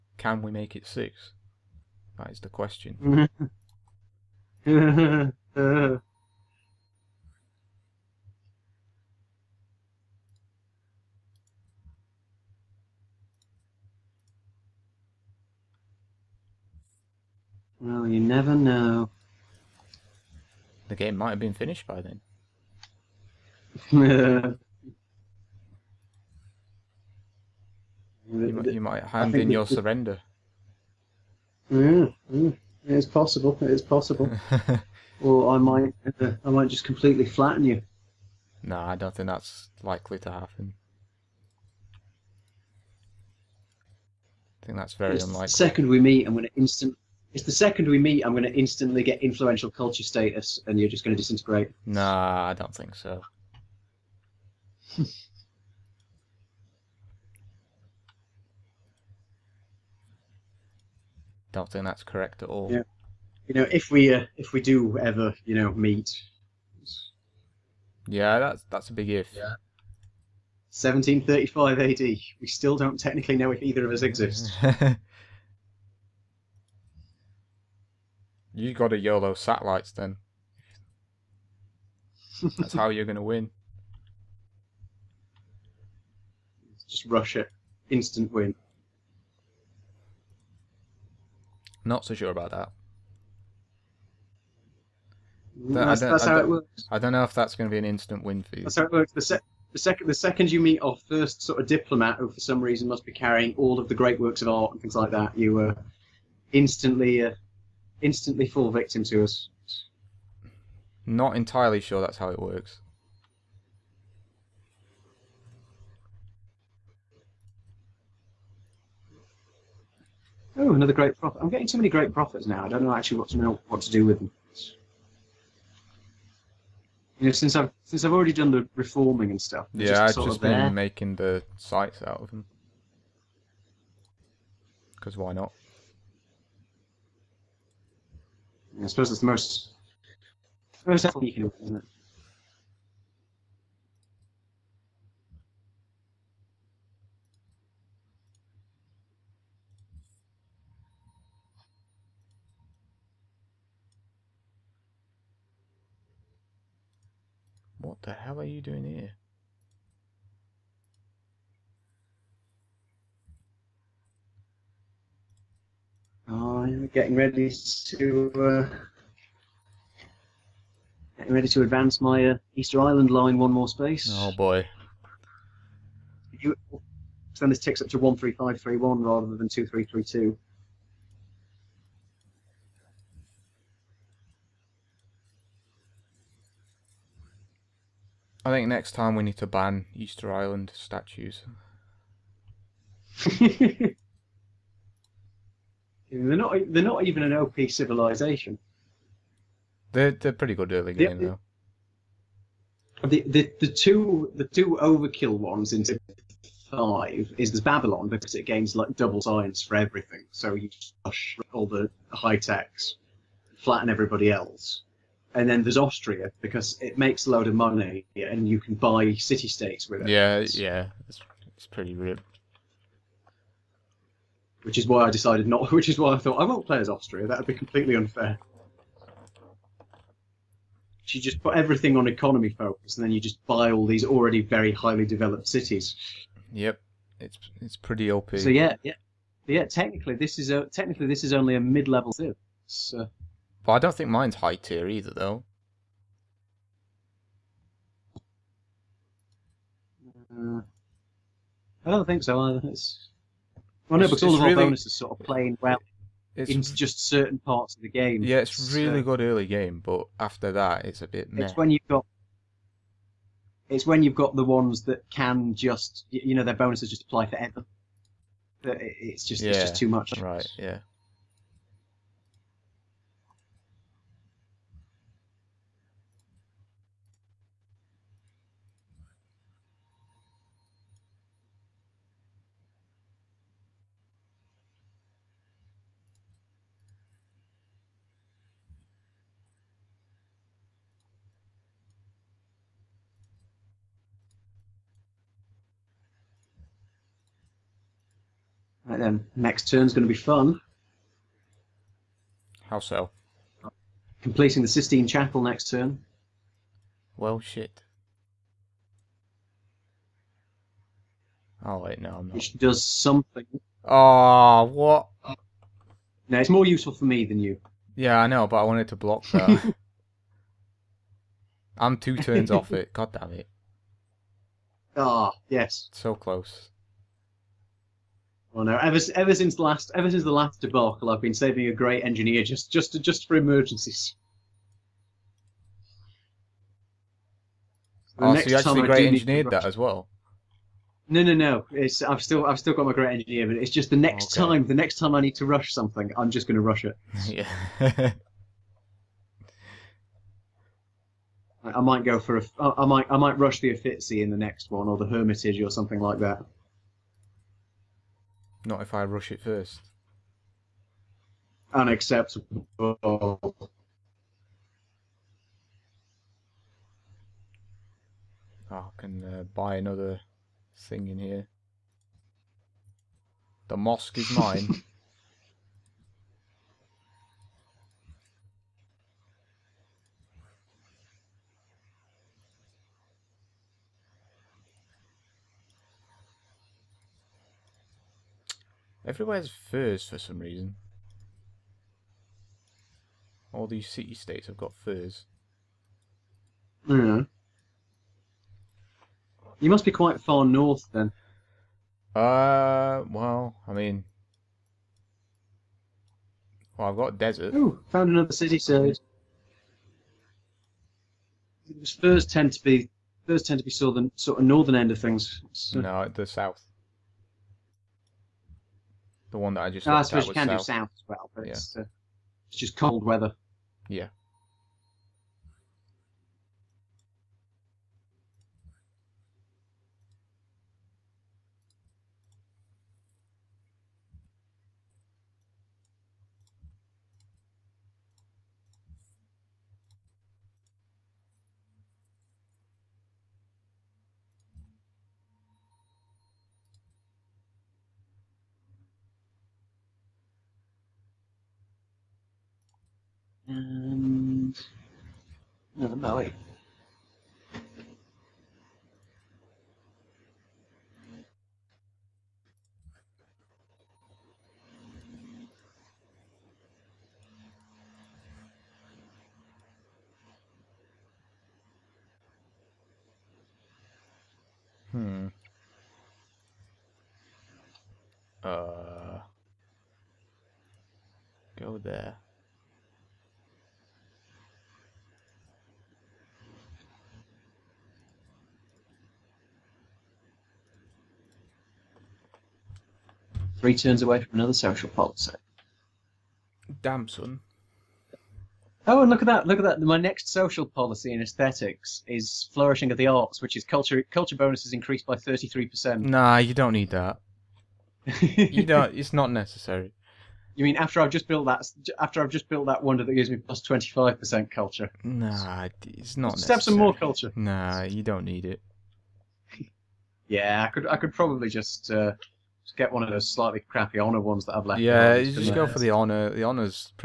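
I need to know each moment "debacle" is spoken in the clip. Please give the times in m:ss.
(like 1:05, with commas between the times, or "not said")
5:30.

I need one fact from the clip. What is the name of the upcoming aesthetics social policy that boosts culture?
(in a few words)
Flourishing of the arts.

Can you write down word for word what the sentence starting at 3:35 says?
And then there's Austria because it makes a load of money and you can buy city states with it.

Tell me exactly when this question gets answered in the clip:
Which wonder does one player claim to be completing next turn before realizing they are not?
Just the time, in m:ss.
5:04.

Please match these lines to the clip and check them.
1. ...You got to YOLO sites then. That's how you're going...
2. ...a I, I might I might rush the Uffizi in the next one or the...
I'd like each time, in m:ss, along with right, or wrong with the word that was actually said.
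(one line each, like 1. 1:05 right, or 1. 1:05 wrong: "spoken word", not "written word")
1. 1:18 wrong: "satellites", not "sites"
2. 5:52 right.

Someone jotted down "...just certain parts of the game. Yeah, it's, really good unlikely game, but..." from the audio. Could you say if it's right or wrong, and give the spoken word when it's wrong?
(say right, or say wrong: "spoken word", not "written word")
wrong: "early", not "unlikely".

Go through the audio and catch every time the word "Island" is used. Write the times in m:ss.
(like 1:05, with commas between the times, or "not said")
2:52, 3:10.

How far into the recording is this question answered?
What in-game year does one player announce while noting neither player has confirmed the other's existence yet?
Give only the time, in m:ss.
1:10.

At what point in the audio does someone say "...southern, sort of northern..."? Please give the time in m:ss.
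6:53.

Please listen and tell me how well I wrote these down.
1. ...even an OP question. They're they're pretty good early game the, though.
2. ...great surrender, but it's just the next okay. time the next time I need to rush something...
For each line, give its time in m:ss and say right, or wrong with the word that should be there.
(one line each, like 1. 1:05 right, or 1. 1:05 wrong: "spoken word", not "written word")
1. 3:17 wrong: "civilization", not "question"
2. 5:42 wrong: "engineer", not "surrender".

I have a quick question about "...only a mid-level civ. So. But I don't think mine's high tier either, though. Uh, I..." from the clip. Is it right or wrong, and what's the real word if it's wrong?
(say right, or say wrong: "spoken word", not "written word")
right.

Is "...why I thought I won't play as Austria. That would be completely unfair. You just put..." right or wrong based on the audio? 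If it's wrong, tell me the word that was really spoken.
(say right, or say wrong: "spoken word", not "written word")
right.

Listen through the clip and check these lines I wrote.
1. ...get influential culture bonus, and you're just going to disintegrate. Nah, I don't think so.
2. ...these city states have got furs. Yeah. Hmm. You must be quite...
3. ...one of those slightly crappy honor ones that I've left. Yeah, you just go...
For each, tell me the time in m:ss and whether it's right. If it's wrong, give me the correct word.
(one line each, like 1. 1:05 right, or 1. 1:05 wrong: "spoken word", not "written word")
1. 0:49 wrong: "status", not "bonus"
2. 6:33 right
3. 8:42 right.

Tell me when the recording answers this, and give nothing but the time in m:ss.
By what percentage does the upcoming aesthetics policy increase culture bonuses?
8:25.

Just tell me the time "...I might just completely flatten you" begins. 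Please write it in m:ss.
0:36.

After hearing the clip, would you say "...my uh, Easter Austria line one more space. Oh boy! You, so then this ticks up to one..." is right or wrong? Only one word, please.
wrong.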